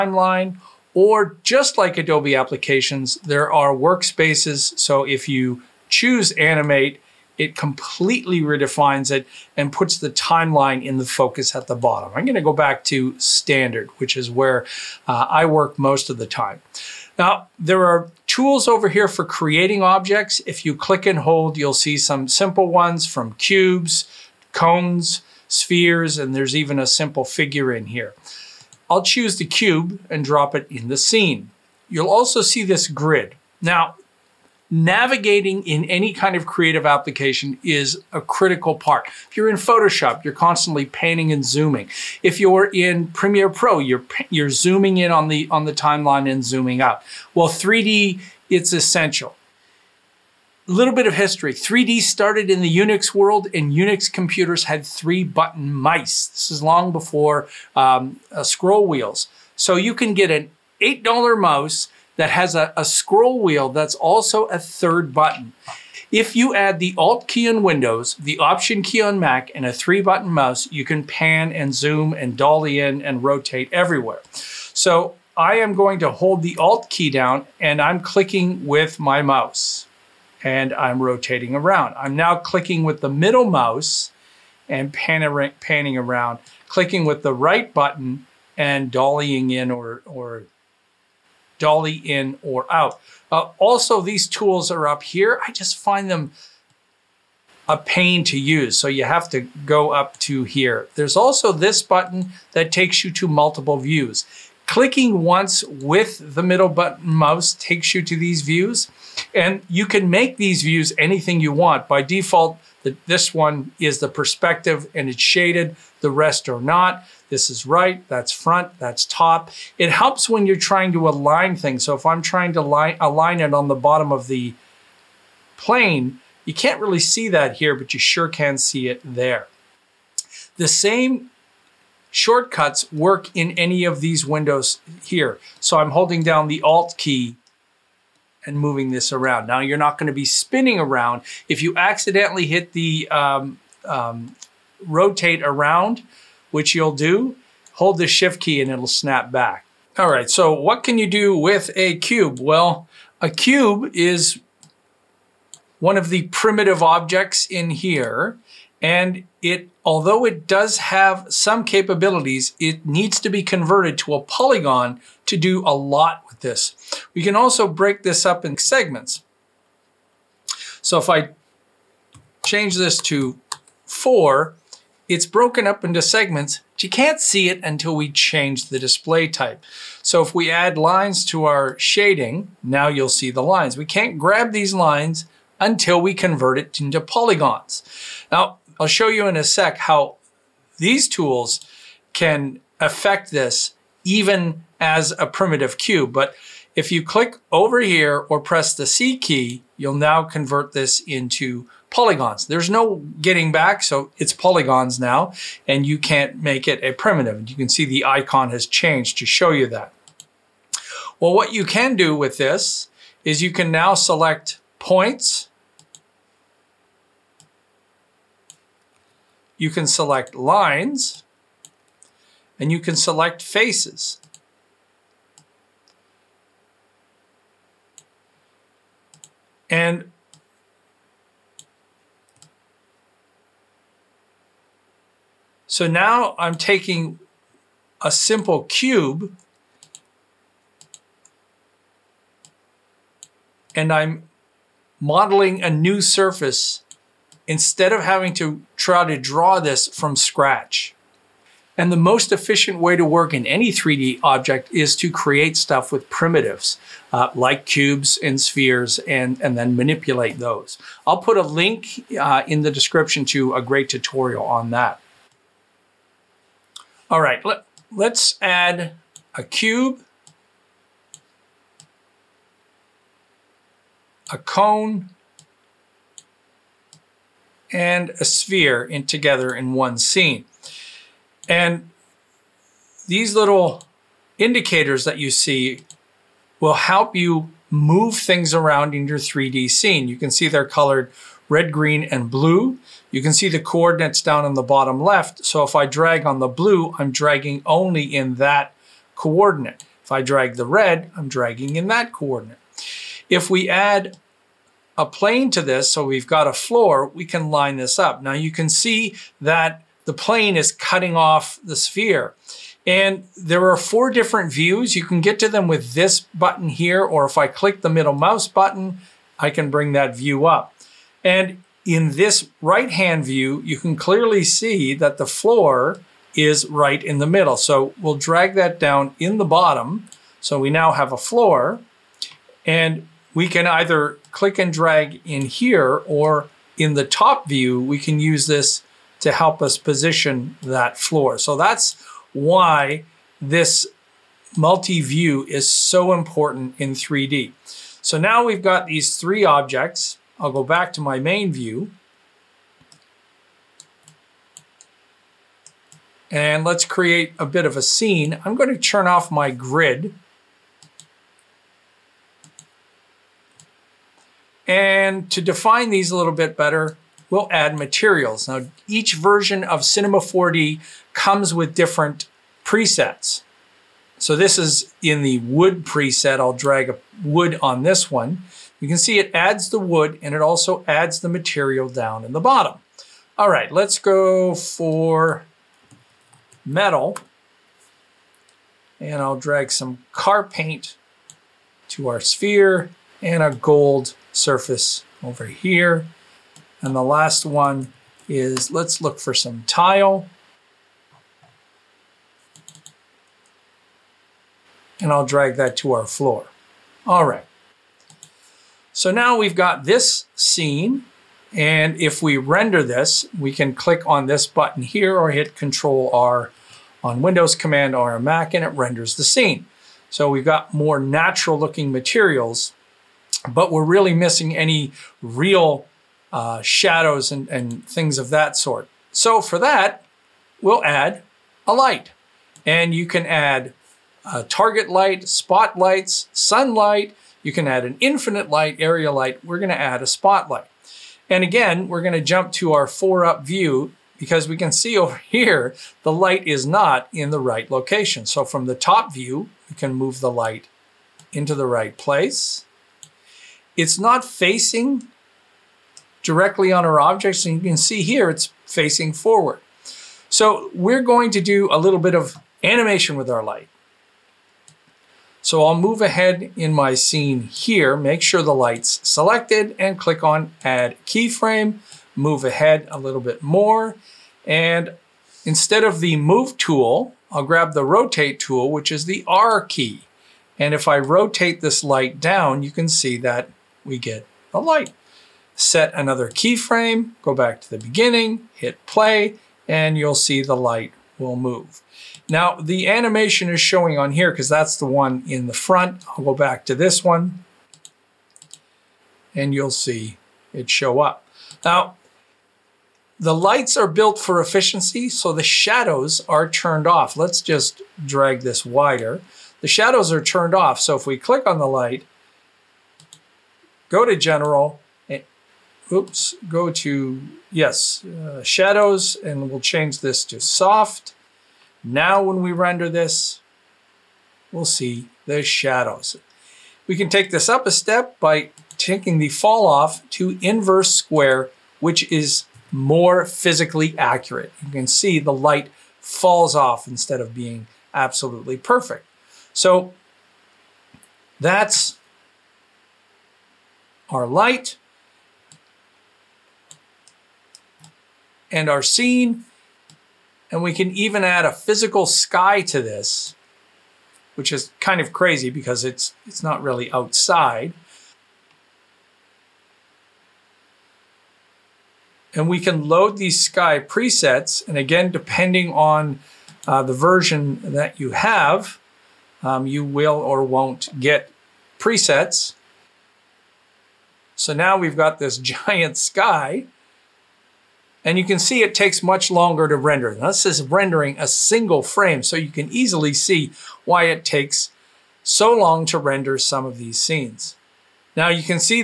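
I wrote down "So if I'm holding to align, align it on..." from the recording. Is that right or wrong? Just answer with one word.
wrong.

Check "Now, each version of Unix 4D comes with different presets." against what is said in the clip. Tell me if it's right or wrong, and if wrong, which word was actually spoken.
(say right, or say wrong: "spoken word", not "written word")
wrong: "Cinema", not "Unix".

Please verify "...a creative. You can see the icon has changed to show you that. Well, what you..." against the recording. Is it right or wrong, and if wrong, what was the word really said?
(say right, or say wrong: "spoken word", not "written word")
wrong: "primitive", not "creative".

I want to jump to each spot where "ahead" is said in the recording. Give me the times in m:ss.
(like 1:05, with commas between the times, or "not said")
7:46, 7:52.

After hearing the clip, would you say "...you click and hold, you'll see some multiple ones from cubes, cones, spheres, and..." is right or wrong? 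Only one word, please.
wrong.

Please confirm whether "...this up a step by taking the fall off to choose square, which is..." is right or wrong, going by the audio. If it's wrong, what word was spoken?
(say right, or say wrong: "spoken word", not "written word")
wrong: "inverse", not "choose".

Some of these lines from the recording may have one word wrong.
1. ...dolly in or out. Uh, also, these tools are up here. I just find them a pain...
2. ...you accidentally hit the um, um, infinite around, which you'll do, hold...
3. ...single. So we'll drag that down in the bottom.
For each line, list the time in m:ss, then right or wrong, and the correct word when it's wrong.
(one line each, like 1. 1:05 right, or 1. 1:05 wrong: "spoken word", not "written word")
1. 1:31 right
2. 2:21 wrong: "rotate", not "infinite"
3. 5:27 wrong: "middle", not "single".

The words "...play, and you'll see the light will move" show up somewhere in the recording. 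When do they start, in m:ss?
8:08.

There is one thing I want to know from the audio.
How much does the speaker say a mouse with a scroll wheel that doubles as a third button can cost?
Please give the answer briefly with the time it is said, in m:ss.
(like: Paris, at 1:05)
$8, at 1:00.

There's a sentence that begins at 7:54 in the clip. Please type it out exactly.
And instead of the move tool, I'll grab the rotate tool, which is the R key.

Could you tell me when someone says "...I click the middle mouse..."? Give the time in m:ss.
5:17.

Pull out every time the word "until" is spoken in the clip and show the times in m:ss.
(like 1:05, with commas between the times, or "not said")
2:57, 3:05.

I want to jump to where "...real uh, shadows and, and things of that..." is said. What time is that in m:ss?
7:05.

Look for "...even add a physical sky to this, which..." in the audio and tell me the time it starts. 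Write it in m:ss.
9:10.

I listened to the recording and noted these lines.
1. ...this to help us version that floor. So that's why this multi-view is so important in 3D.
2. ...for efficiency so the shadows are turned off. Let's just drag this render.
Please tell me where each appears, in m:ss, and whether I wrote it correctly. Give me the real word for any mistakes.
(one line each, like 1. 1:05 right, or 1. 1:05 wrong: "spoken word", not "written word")
1. 5:38 wrong: "position", not "version"
2. 8:24 wrong: "wider", not "render".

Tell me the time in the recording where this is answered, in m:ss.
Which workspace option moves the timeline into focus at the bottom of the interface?
0:06.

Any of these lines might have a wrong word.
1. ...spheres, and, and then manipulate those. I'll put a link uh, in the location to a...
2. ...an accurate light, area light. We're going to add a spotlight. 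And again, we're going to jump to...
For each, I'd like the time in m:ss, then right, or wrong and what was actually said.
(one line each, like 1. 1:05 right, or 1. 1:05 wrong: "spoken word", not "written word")
1. 4:18 wrong: "description", not "location"
2. 7:17 wrong: "infinite", not "accurate".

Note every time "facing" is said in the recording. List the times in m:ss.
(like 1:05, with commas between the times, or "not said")
7:34, 7:38.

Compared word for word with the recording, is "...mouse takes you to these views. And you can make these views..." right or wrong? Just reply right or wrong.
right.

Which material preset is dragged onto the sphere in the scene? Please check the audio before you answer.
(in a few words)
Car paint.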